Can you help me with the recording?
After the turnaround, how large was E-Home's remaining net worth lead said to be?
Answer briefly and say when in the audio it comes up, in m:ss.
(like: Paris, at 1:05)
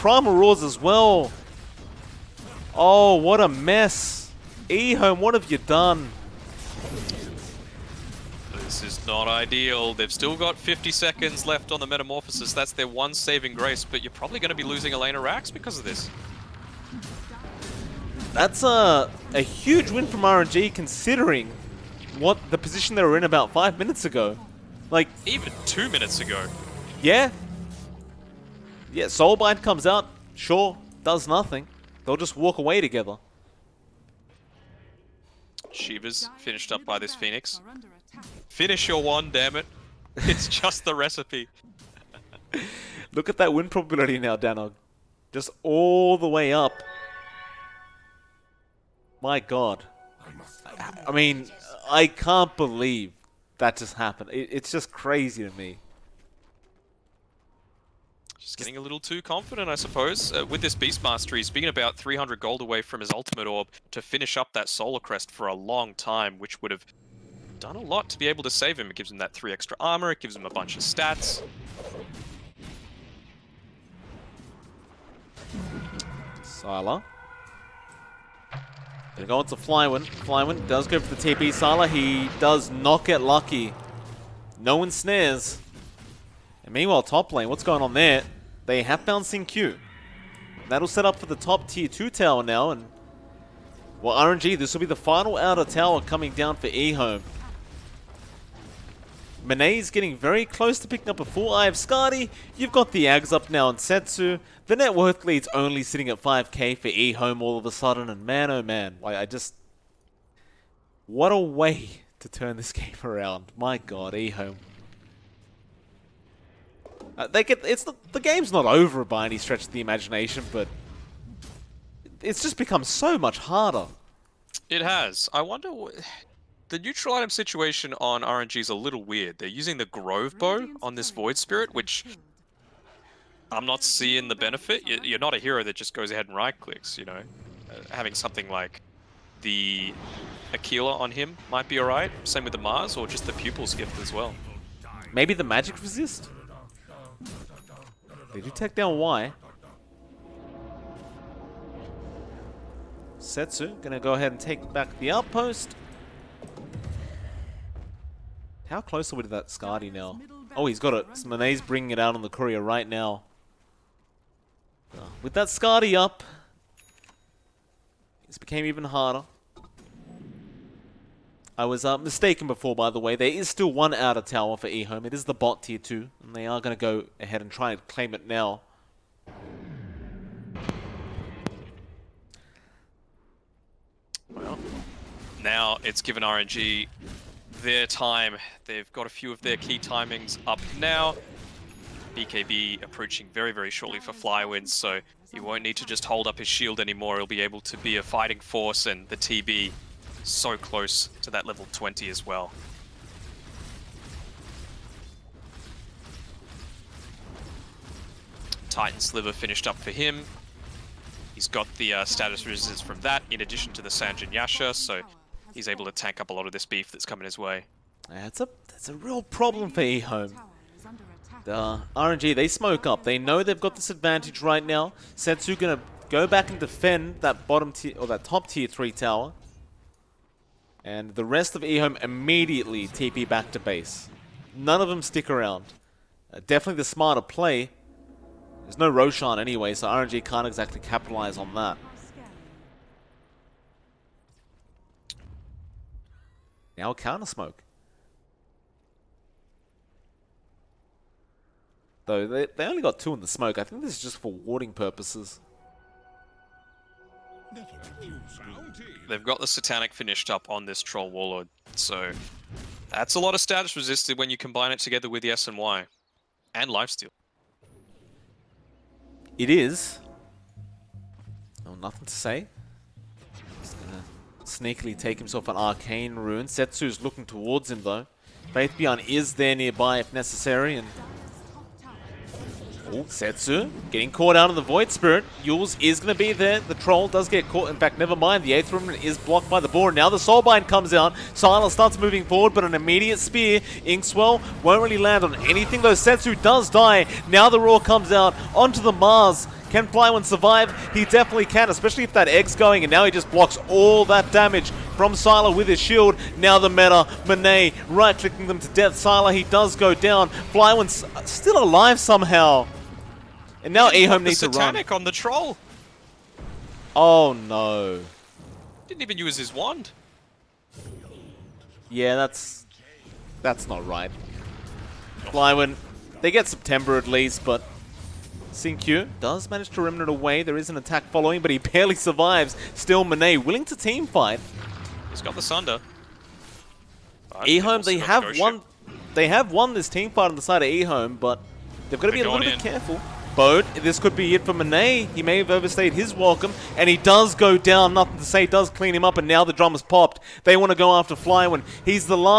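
5k, at 1:46.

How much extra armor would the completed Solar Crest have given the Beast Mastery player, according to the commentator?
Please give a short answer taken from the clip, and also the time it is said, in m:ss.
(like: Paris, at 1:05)
3, at 1:09.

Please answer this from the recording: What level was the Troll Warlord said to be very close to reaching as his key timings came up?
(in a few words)
20.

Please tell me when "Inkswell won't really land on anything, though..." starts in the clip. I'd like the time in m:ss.
4:53.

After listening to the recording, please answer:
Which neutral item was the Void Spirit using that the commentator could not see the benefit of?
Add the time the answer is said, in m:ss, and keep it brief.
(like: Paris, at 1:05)
Grove Bow, at 2:09.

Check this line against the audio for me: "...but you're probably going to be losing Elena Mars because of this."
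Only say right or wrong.
wrong.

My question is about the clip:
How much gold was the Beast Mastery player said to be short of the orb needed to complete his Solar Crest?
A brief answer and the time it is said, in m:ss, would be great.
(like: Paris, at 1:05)
300 gold, at 1:01.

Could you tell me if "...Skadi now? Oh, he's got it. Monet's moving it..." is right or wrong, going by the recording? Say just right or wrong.
wrong.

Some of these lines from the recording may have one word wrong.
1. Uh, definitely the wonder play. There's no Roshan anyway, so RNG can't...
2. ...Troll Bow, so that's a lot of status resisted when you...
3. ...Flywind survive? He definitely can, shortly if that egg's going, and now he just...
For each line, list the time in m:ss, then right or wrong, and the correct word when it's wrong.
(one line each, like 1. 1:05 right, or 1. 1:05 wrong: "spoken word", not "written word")
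1. 3:56 wrong: "smarter", not "wonder"
2. 4:20 wrong: "Warlord", not "Bow"
3. 4:59 wrong: "especially", not "shortly".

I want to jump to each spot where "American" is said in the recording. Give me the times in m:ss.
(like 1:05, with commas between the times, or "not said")
not said.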